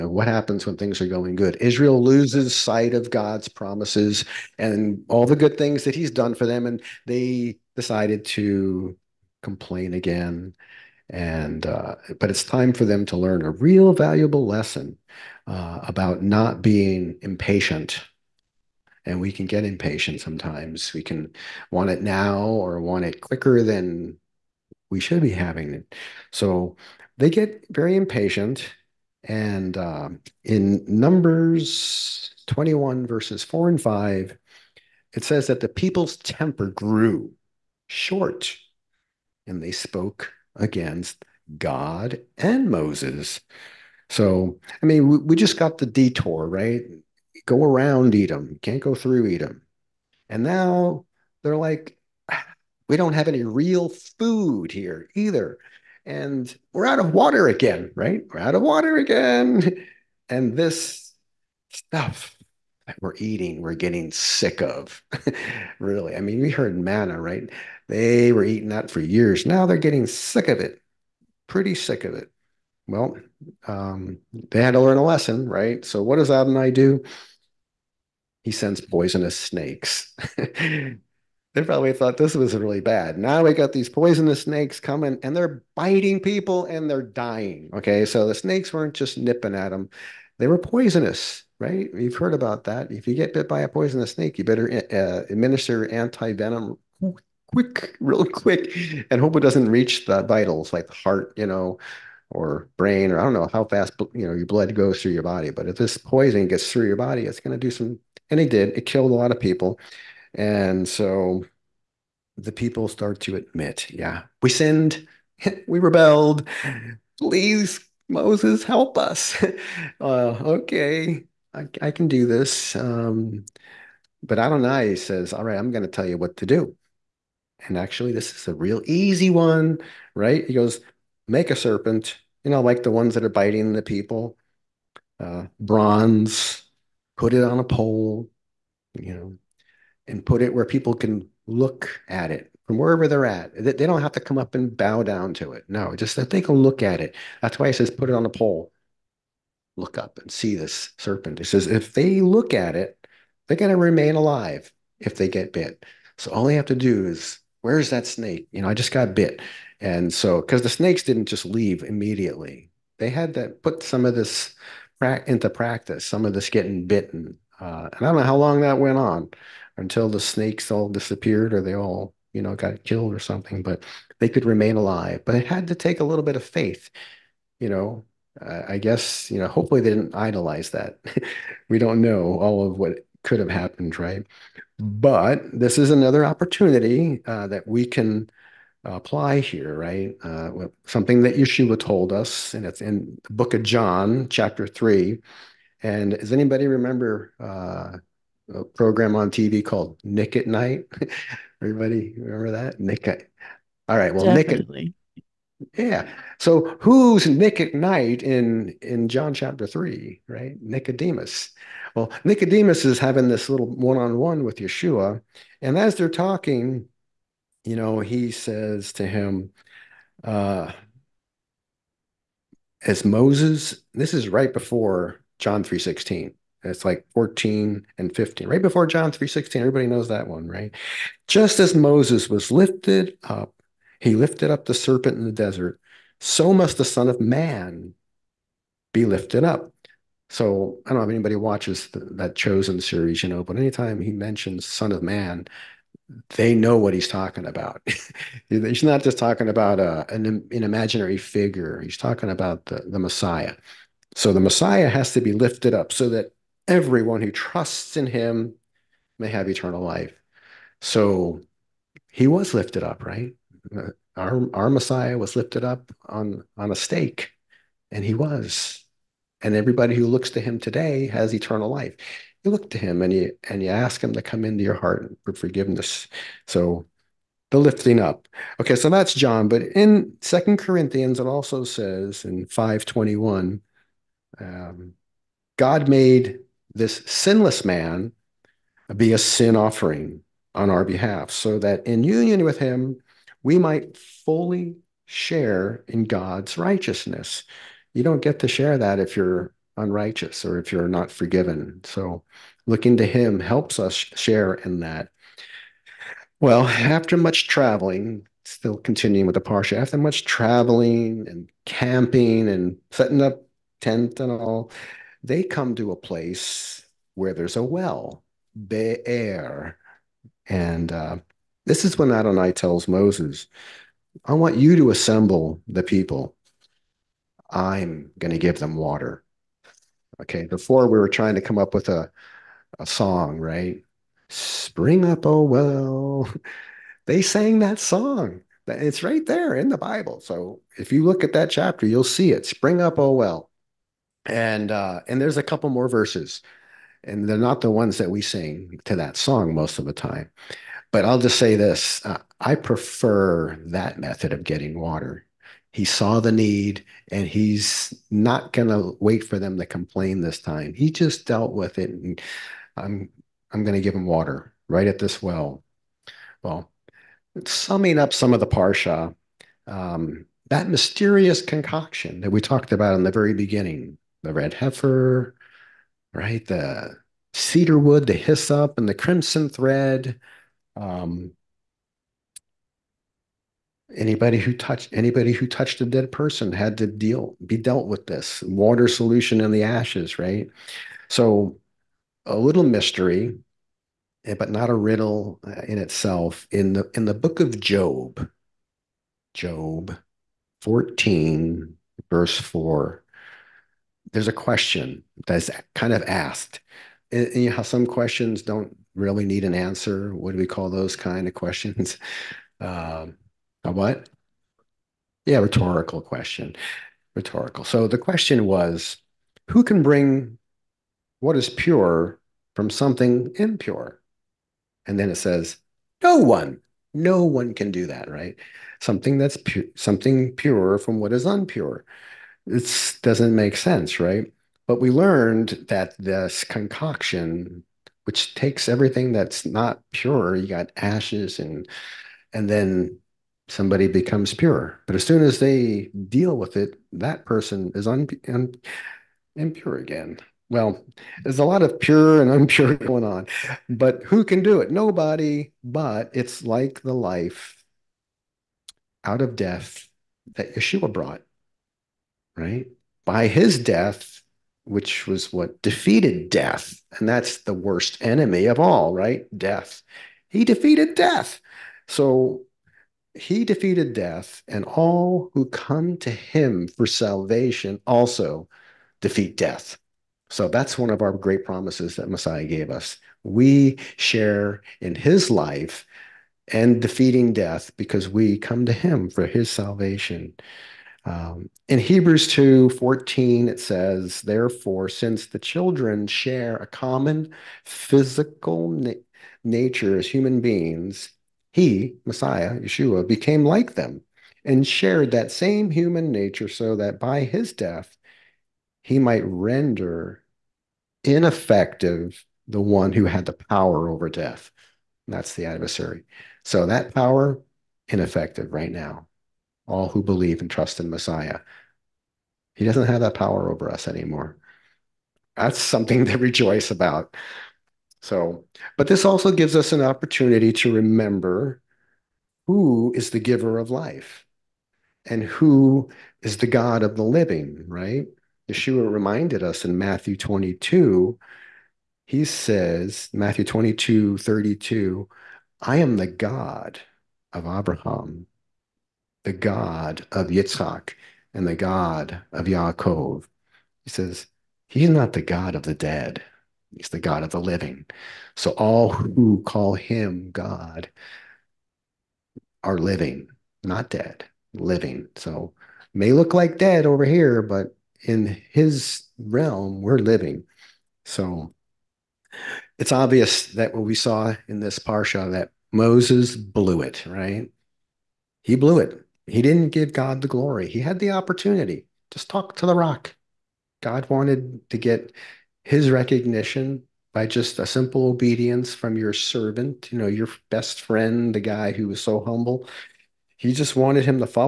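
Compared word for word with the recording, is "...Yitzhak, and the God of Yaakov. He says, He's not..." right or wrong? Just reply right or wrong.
right.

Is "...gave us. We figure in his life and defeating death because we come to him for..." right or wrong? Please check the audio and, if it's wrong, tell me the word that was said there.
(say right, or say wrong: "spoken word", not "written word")
wrong: "share", not "figure".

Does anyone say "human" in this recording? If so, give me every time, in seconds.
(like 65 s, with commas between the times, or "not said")
500 s, 505 s.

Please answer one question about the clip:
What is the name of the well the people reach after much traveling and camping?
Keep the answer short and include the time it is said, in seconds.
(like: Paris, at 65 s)
Be'er, at 318 s.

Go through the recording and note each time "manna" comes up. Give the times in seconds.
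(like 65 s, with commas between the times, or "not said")
66 s.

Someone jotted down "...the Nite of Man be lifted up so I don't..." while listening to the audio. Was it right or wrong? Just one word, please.
wrong.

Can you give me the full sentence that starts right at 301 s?
So looking to him helps us share in that.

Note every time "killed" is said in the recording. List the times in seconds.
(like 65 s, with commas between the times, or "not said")
108 s, 172 s.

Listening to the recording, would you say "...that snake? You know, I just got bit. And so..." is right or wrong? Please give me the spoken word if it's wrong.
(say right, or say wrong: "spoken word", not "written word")
right.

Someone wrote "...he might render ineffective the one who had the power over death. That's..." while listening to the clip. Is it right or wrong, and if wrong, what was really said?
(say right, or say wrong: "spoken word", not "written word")
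right.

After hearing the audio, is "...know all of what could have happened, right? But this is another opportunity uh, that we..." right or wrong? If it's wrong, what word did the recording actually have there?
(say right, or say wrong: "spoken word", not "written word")
right.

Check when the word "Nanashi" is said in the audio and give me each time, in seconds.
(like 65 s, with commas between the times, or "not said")
not said.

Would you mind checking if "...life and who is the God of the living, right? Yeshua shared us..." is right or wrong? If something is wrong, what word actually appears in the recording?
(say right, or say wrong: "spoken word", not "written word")
wrong: "reminded", not "shared".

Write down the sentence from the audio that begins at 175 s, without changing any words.
But it had to take a little bit of faith, you know.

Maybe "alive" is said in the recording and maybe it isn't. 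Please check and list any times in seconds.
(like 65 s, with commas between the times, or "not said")
154 s, 174 s.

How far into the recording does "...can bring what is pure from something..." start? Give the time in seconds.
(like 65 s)
419 s.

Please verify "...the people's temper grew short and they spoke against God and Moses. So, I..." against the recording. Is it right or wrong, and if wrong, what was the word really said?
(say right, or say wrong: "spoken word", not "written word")
right.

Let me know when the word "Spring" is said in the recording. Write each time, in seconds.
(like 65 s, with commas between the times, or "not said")
334 s, 342 s.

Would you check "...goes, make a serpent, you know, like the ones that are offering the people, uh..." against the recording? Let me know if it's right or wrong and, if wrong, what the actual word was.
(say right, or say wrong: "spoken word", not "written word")
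wrong: "biting", not "offering".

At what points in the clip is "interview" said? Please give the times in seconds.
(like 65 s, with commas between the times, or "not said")
not said.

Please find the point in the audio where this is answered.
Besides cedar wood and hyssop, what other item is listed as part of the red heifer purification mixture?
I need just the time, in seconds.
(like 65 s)
378 s.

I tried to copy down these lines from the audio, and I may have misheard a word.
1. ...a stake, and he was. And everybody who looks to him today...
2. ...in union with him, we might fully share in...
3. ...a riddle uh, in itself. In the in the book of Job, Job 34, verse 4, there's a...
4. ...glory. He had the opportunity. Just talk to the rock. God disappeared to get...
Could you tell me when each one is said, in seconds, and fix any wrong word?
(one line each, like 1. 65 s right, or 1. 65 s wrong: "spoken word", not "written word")
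1. 266 s right
2. 291 s right
3. 394 s wrong: "14", not "34"
4. 580 s wrong: "wanted", not "disappeared".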